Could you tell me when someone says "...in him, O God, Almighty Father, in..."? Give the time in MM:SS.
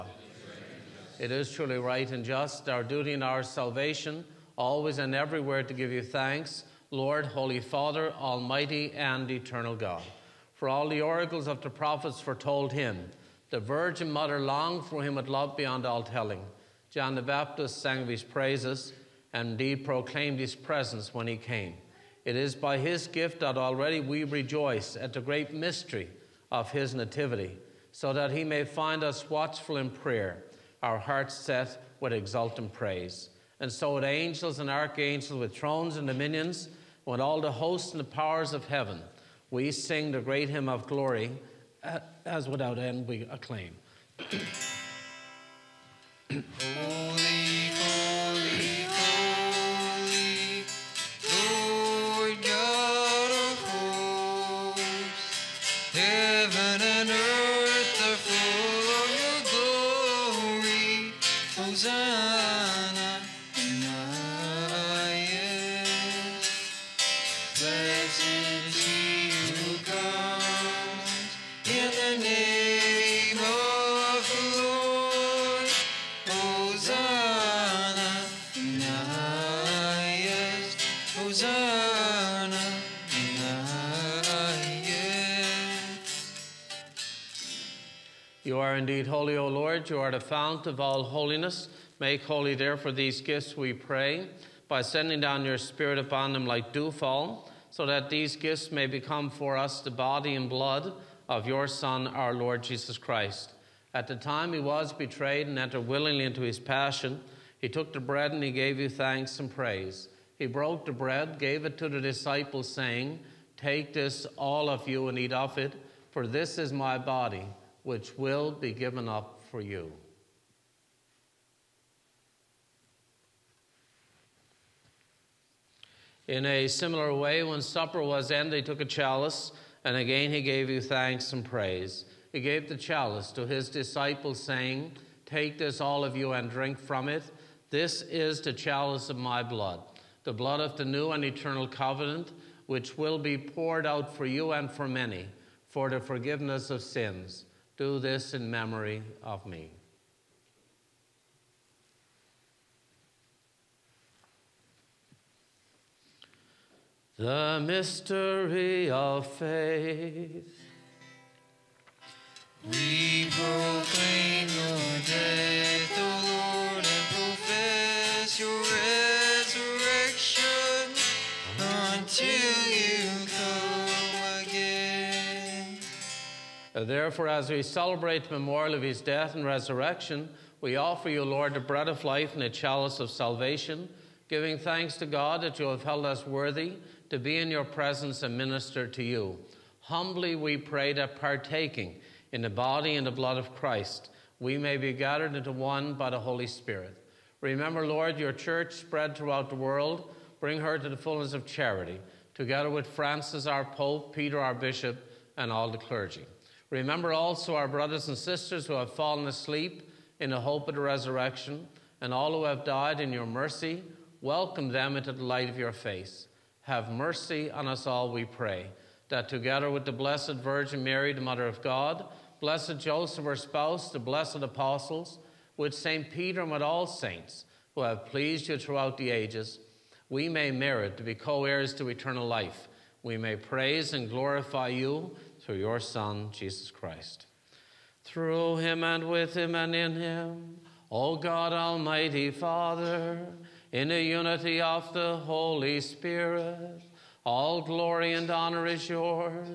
03:59.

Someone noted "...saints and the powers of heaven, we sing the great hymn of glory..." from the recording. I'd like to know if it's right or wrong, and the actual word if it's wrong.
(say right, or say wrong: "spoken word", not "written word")
wrong: "hosts", not "saints".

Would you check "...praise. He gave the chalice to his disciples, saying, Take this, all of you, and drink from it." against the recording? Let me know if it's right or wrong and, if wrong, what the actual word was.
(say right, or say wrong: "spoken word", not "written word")
right.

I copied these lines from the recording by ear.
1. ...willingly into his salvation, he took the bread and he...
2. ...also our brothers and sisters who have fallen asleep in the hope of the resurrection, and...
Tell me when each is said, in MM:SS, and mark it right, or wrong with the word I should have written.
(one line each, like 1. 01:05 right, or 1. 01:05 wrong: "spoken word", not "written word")
1. 01:45 wrong: "passion", not "salvation"
2. 03:27 right.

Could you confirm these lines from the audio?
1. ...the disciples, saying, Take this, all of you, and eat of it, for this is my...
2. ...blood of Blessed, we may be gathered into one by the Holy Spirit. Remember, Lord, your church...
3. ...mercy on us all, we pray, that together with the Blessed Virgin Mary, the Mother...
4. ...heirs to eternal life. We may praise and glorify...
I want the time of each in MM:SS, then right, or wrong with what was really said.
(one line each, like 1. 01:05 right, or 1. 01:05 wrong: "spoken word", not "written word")
1. 01:51 right
2. 03:13 wrong: "Christ", not "Blessed"
3. 03:36 right
4. 03:51 right.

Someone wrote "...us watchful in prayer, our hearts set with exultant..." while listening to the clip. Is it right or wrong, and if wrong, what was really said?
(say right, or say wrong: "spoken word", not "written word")
right.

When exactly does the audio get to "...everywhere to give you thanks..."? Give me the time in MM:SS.
00:05.